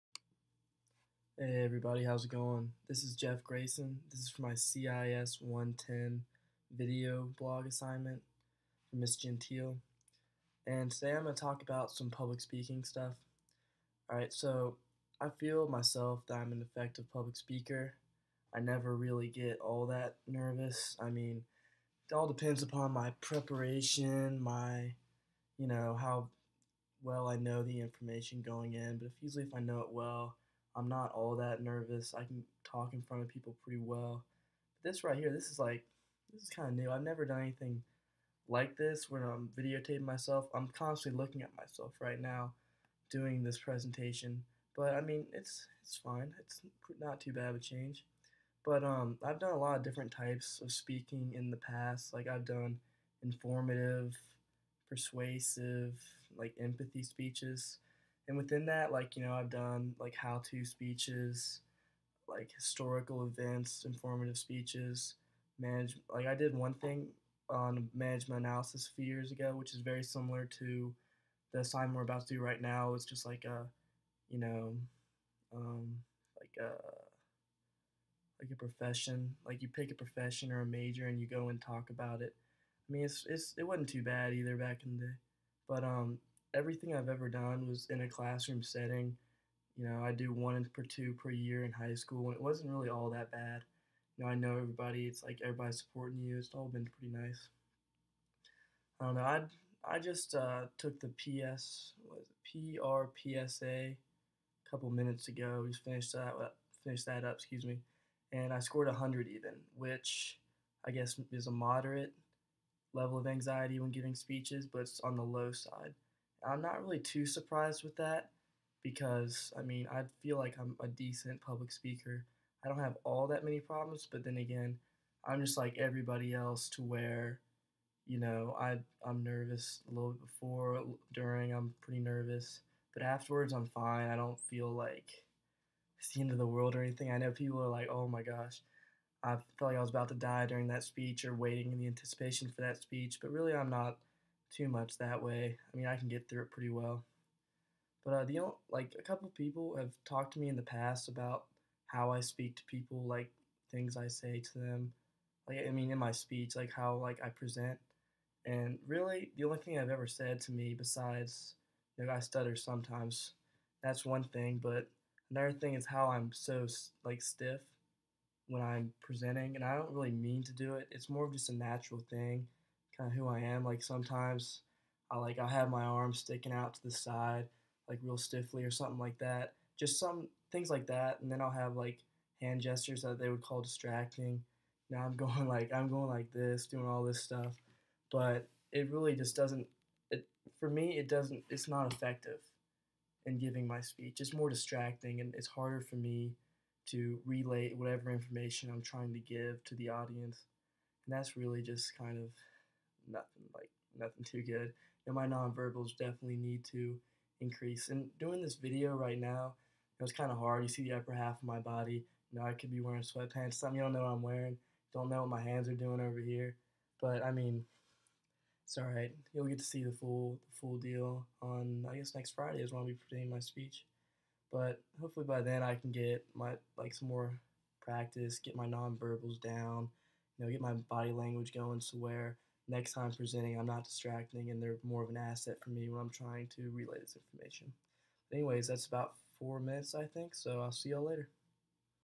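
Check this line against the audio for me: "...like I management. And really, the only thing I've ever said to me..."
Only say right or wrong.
wrong.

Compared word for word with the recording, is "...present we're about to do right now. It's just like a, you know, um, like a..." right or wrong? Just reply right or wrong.
wrong.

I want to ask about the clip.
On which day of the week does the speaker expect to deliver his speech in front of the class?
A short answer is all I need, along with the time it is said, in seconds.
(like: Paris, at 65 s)
Friday, at 222 s.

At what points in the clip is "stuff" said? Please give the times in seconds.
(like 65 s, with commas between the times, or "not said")
12 s, 187 s.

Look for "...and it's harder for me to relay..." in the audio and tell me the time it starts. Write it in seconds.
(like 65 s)
195 s.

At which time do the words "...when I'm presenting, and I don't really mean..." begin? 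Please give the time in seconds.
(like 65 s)
168 s.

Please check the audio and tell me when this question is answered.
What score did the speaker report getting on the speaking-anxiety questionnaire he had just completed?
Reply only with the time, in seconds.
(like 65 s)
108 s.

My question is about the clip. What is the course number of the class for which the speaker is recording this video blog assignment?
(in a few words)
CIS 110.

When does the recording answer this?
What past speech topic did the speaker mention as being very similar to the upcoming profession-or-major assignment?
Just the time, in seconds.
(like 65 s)
67 s.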